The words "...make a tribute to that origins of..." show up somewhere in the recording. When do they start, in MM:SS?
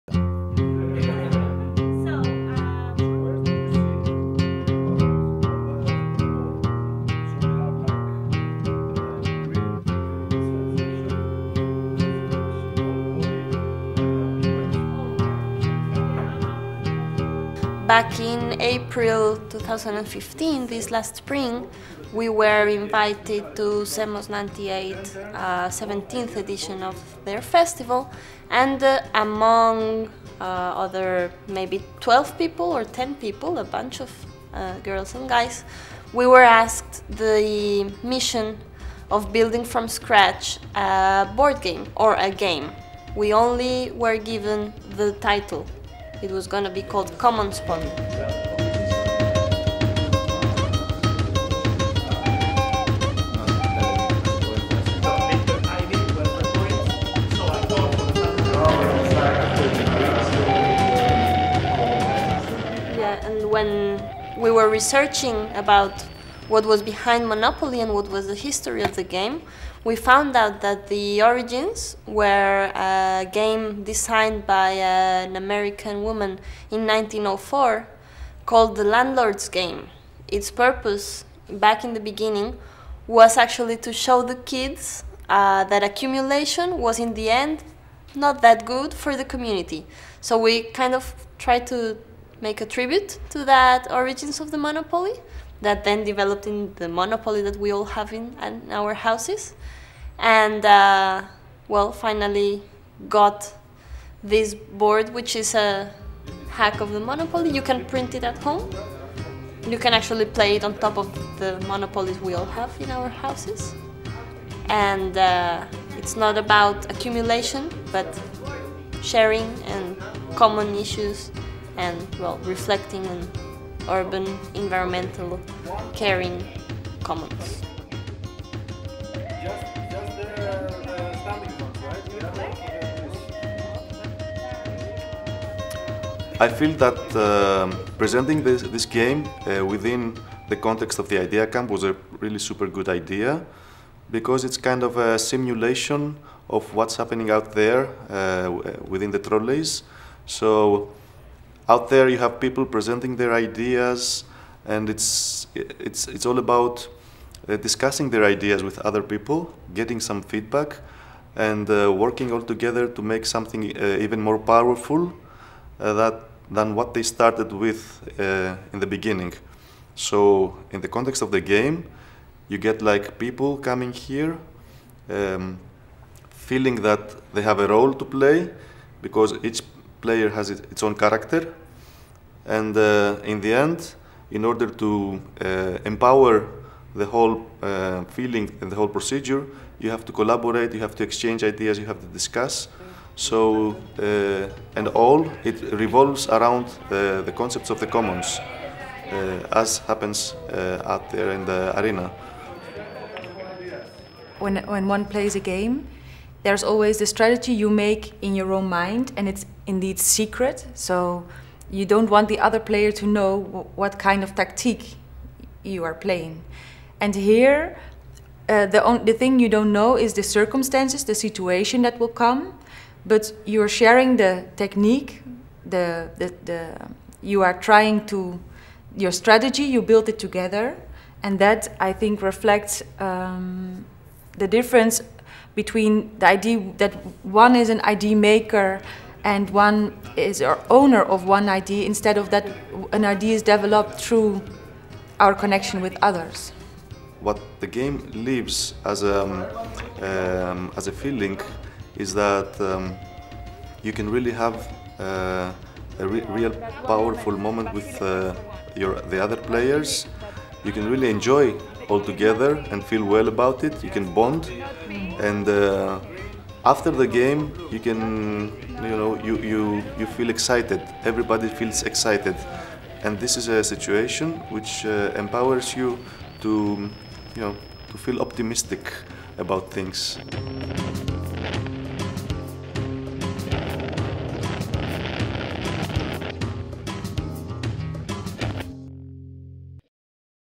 01:32.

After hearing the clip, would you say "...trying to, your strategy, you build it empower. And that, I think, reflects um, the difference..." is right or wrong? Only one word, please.
wrong.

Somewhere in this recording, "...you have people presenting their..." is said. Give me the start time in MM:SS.
02:32.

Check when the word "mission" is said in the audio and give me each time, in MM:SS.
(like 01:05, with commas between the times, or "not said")
00:38.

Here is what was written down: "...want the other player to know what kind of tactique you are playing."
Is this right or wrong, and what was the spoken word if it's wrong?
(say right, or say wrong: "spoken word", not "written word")
right.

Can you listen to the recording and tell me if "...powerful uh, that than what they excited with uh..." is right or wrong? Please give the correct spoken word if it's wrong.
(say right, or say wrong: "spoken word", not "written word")
wrong: "started", not "excited".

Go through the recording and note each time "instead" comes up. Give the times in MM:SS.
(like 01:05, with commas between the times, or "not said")
04:01.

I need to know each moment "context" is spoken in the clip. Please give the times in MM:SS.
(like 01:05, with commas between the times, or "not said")
02:20, 02:50.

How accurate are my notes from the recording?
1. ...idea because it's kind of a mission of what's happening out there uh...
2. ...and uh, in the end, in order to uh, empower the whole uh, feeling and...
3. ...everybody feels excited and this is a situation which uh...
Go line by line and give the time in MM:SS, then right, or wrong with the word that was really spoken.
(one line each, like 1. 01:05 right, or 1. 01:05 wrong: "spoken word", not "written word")
1. 02:22 wrong: "simulation", not "mission"
2. 03:02 right
3. 04:31 right.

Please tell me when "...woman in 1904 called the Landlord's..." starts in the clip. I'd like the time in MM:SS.
01:16.